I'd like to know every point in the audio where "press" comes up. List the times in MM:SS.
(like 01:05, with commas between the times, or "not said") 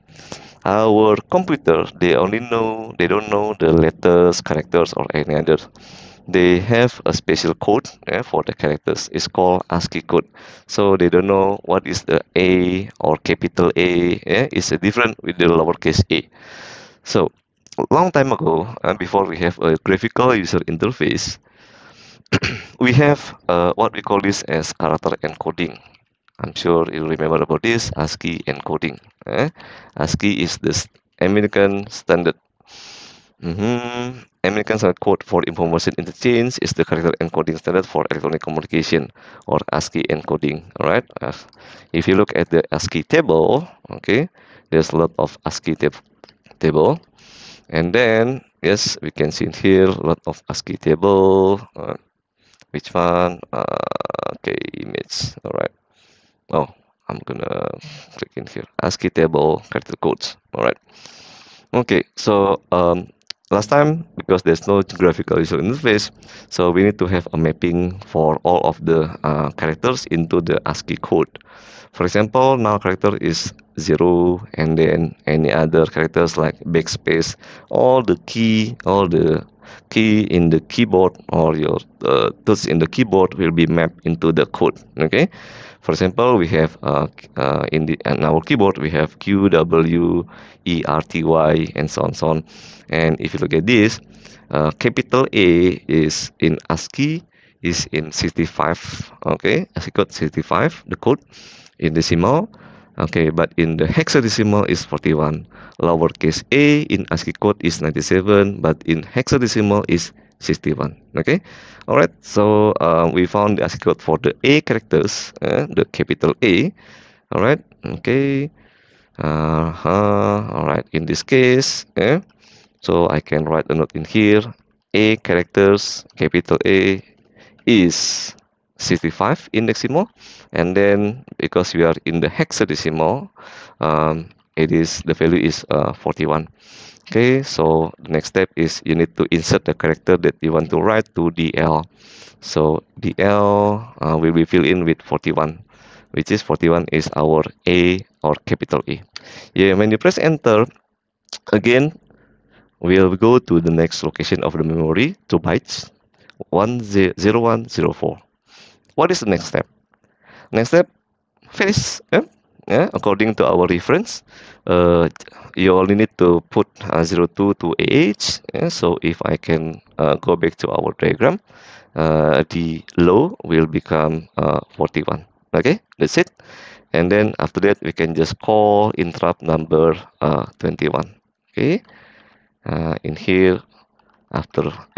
02:29.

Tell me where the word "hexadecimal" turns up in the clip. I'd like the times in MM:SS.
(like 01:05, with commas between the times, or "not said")
01:43, 01:49, 02:12.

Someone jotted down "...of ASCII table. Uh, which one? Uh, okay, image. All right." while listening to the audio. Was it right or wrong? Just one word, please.
right.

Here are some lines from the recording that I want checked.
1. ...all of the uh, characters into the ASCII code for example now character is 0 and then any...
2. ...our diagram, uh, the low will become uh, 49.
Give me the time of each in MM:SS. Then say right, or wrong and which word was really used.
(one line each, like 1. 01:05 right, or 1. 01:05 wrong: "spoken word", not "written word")
1. 01:08 right
2. 02:50 wrong: "41", not "49".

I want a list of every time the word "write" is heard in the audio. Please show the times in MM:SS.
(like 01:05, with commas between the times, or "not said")
02:03, 02:20.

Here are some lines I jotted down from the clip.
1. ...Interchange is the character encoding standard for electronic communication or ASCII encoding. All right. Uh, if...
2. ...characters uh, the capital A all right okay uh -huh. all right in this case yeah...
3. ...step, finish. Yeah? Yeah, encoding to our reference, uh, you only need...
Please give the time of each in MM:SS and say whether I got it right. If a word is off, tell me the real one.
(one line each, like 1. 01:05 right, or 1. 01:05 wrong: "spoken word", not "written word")
1. 00:35 right
2. 01:54 right
3. 02:40 wrong: "according", not "encoding".